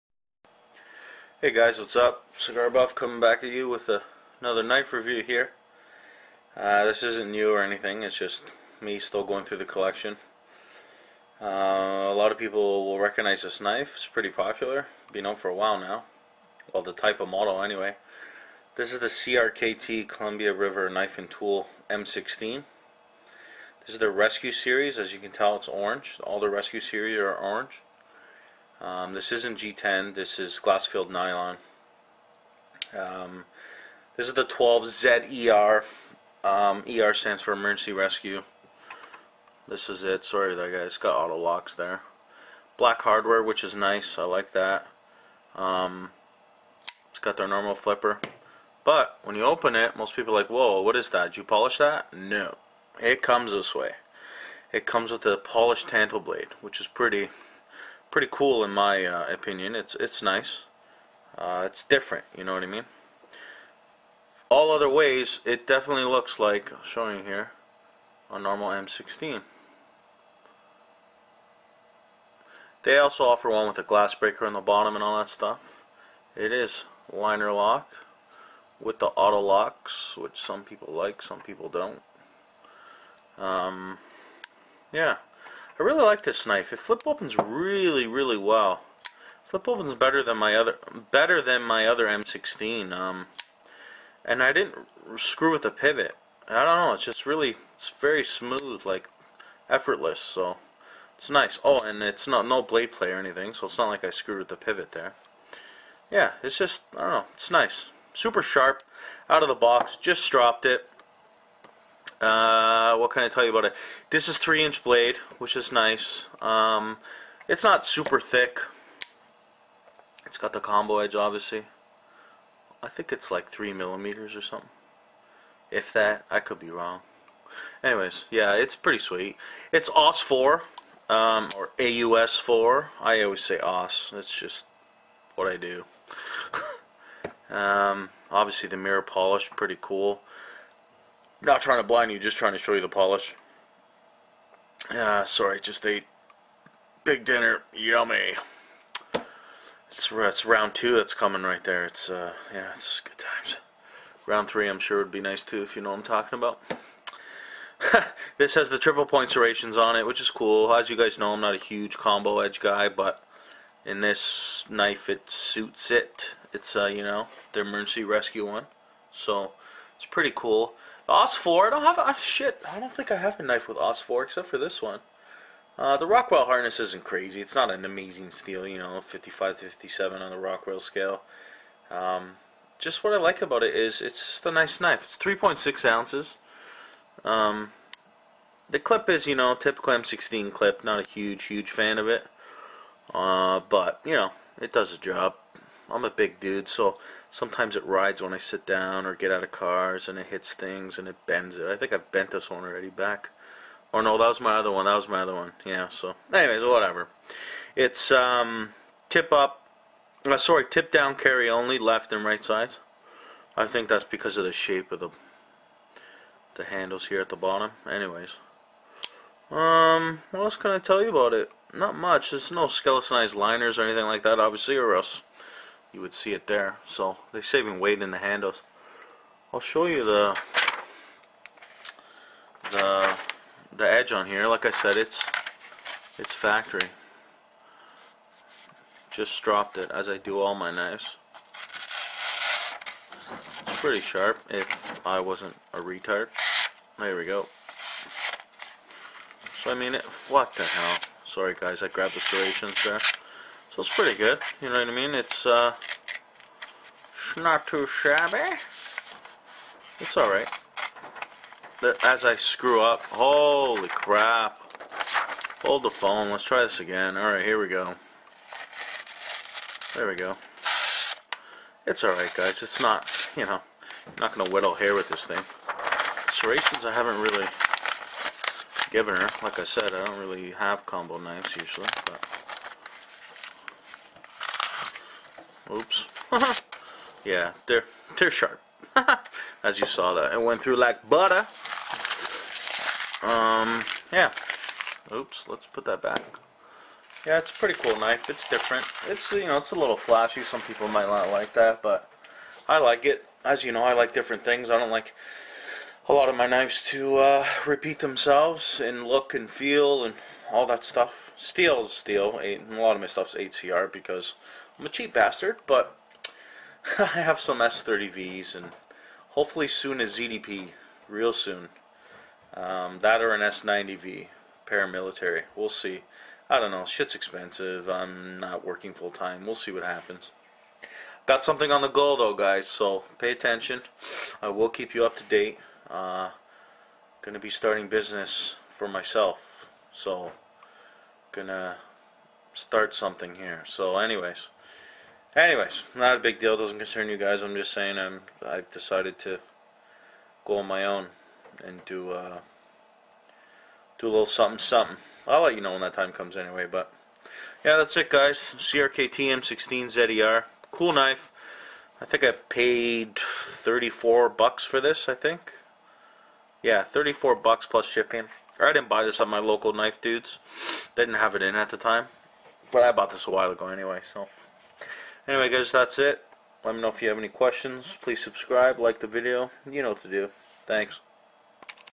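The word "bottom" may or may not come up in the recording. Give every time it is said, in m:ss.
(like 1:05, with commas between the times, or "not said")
1:14, 3:37.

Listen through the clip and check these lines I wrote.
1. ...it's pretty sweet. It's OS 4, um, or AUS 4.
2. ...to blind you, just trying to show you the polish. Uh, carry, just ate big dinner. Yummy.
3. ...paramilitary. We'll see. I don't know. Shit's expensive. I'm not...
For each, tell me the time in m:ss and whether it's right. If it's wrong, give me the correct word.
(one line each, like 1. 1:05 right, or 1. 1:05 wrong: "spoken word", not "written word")
1. 2:08 right
2. 2:21 wrong: "sorry", not "carry"
3. 5:24 right.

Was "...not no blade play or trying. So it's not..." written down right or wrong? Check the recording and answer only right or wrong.
wrong.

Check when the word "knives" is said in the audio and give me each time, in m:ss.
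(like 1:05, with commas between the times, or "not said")
4:00, 4:41, 5:06.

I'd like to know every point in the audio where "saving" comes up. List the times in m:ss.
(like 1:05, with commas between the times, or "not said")
3:47.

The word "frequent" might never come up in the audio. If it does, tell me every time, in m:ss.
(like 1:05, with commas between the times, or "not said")
not said.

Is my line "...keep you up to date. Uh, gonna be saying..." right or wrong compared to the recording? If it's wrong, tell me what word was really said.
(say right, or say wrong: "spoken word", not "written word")
wrong: "starting", not "saying".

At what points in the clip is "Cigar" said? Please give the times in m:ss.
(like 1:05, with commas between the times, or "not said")
0:02.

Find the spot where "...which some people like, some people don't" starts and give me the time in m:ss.
1:20.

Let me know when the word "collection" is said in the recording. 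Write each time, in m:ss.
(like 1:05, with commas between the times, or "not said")
0:09.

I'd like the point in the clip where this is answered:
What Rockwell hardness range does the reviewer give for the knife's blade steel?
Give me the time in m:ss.
2:59.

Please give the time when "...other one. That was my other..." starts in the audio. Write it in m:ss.
3:24.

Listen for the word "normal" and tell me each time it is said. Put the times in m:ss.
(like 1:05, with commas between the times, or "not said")
0:47, 1:08.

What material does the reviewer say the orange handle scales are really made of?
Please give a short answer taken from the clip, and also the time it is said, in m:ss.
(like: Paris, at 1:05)
Glass-filled nylon, at 0:30.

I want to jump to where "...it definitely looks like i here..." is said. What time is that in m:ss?
1:05.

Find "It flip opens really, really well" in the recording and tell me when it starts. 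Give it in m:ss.
1:26.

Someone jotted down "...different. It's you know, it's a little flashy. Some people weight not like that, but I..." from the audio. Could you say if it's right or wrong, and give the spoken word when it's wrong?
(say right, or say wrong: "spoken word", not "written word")
wrong: "might", not "weight".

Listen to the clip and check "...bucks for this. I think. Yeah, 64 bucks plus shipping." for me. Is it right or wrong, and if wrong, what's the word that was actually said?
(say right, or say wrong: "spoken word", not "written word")
wrong: "34", not "64".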